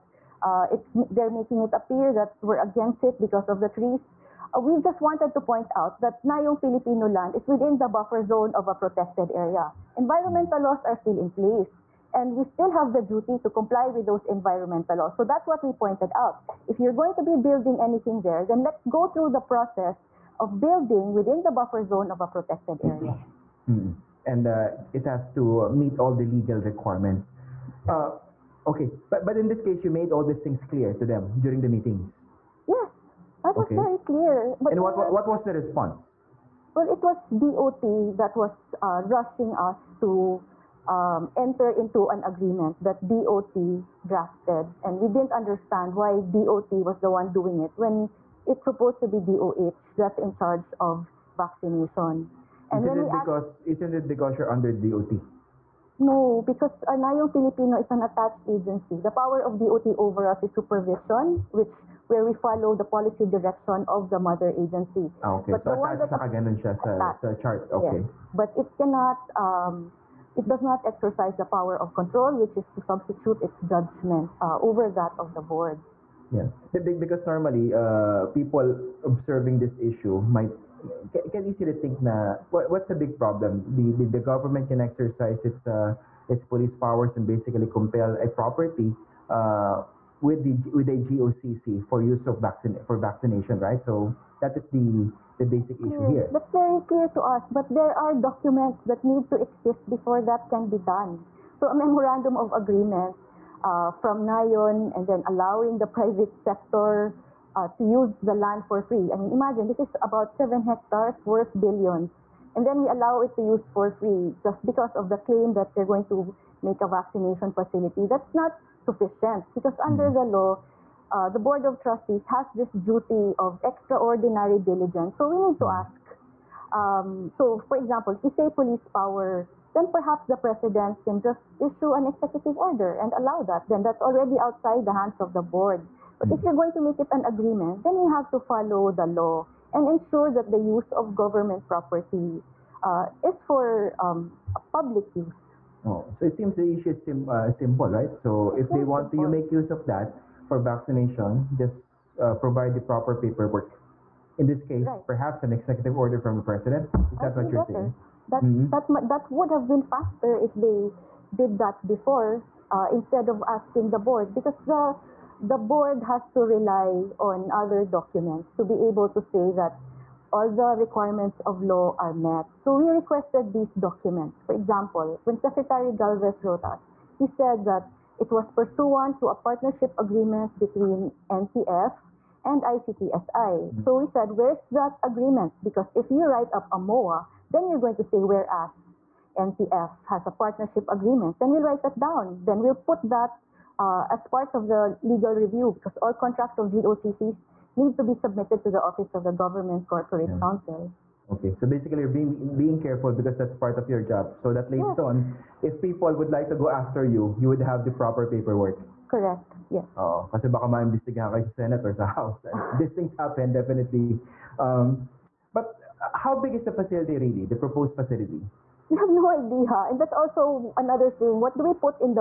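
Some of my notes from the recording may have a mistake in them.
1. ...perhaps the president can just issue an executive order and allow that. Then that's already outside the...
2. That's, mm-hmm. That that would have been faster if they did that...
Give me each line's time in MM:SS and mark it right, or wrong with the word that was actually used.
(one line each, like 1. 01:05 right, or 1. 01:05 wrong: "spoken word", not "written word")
1. 02:09 right
2. 02:38 right.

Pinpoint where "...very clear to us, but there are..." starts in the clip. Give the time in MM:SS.
01:36.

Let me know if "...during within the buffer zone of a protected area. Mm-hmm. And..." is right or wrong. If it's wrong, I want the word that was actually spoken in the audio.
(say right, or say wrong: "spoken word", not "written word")
wrong: "building", not "during".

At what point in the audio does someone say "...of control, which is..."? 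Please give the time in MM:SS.
01:11.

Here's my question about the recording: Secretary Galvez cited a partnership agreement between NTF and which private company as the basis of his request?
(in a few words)
ICTSI.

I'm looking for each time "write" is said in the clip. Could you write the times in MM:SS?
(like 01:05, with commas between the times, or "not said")
03:06, 03:11.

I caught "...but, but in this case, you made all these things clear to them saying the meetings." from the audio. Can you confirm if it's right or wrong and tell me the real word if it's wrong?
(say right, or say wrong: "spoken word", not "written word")
wrong: "during", not "saying".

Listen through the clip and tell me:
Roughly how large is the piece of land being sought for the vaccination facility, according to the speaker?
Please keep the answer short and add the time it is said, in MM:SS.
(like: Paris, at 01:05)
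7 hectares, at 01:50.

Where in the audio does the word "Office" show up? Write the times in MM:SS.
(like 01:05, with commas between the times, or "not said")
03:18.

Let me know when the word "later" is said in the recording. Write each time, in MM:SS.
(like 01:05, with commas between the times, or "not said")
03:24.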